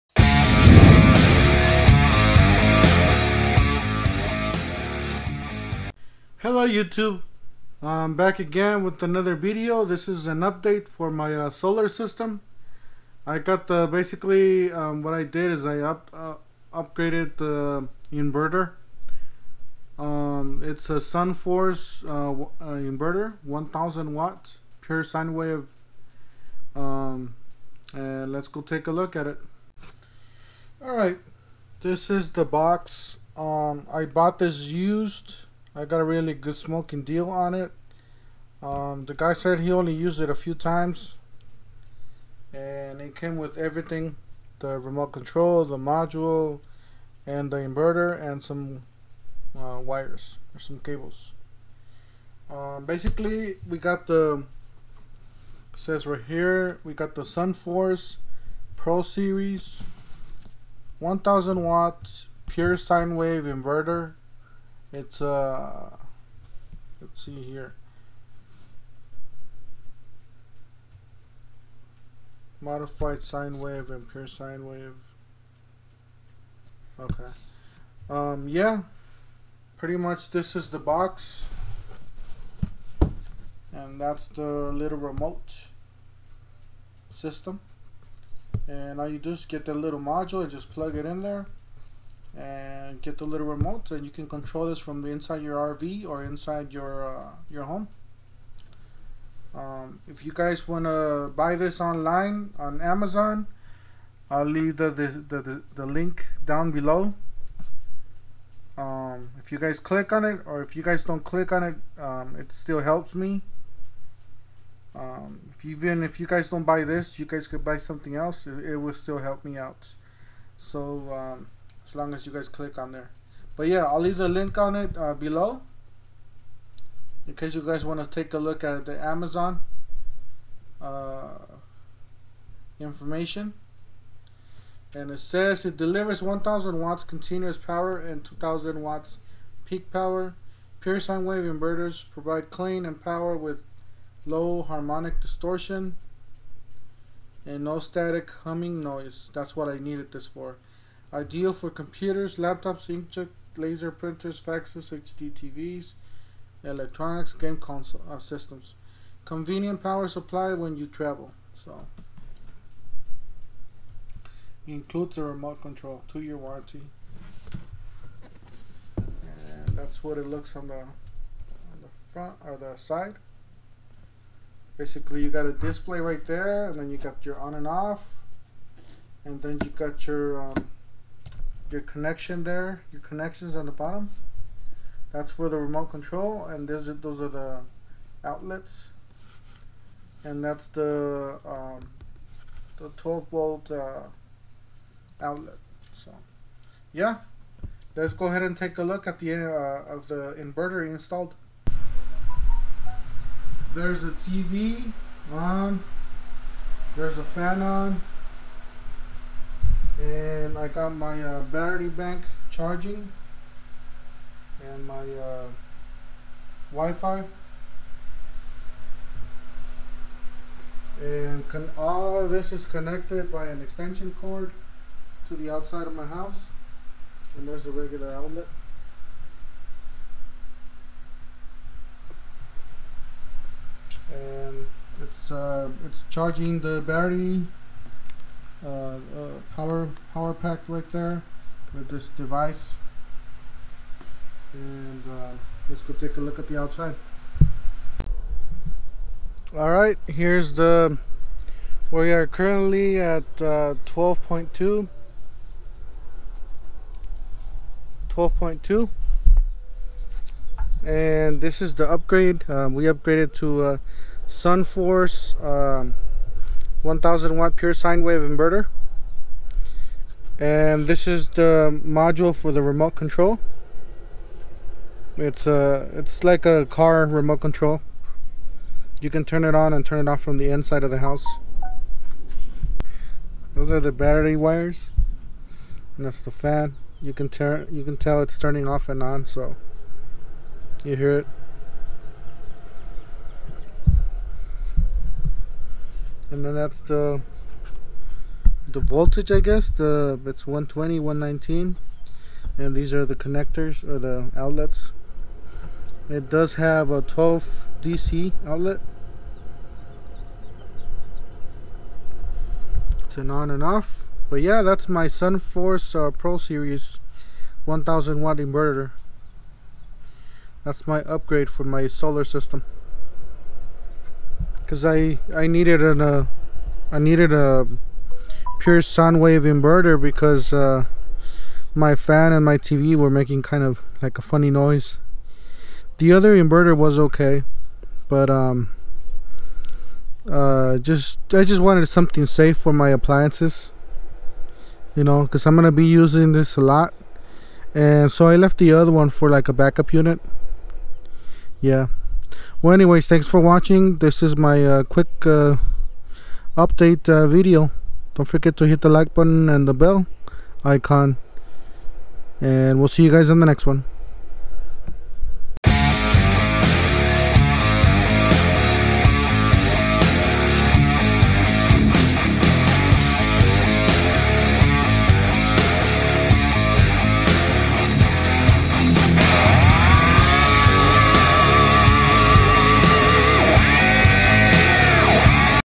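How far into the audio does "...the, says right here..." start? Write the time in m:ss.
0:54.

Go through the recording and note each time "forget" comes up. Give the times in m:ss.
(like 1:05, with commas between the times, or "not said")
5:58.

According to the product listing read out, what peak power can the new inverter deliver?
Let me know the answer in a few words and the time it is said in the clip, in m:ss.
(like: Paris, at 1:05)
2000 watts, at 2:18.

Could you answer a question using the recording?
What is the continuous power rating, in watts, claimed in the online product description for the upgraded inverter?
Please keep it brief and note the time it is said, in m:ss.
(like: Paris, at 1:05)
1000 watts, at 2:16.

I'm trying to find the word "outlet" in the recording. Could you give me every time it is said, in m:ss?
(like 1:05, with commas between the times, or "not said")
3:08, 3:15, 3:48, 5:04, 5:08.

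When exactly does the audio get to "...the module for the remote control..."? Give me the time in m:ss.
4:31.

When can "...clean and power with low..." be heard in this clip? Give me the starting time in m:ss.
2:22.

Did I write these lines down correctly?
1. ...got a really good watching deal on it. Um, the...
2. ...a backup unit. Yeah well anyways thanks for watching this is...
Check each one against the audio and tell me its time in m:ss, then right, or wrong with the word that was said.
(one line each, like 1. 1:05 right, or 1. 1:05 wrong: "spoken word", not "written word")
1. 0:35 wrong: "smoking", not "watching"
2. 5:49 right.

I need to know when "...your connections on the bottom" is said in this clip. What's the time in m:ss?
3:02.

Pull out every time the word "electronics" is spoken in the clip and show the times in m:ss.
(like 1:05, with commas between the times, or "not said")
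2:36.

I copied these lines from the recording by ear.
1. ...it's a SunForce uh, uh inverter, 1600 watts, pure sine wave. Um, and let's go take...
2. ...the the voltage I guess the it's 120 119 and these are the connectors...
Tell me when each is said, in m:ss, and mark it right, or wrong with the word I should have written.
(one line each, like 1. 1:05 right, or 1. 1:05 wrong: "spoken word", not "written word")
1. 0:20 wrong: "1000", not "1600"
2. 4:56 right.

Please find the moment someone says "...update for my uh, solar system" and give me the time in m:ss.
0:10.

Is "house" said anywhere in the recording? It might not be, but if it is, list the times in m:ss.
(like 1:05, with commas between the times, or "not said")
3:46, 4:40.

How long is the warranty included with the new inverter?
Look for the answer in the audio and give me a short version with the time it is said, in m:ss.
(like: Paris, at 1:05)
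two-year, at 2:46.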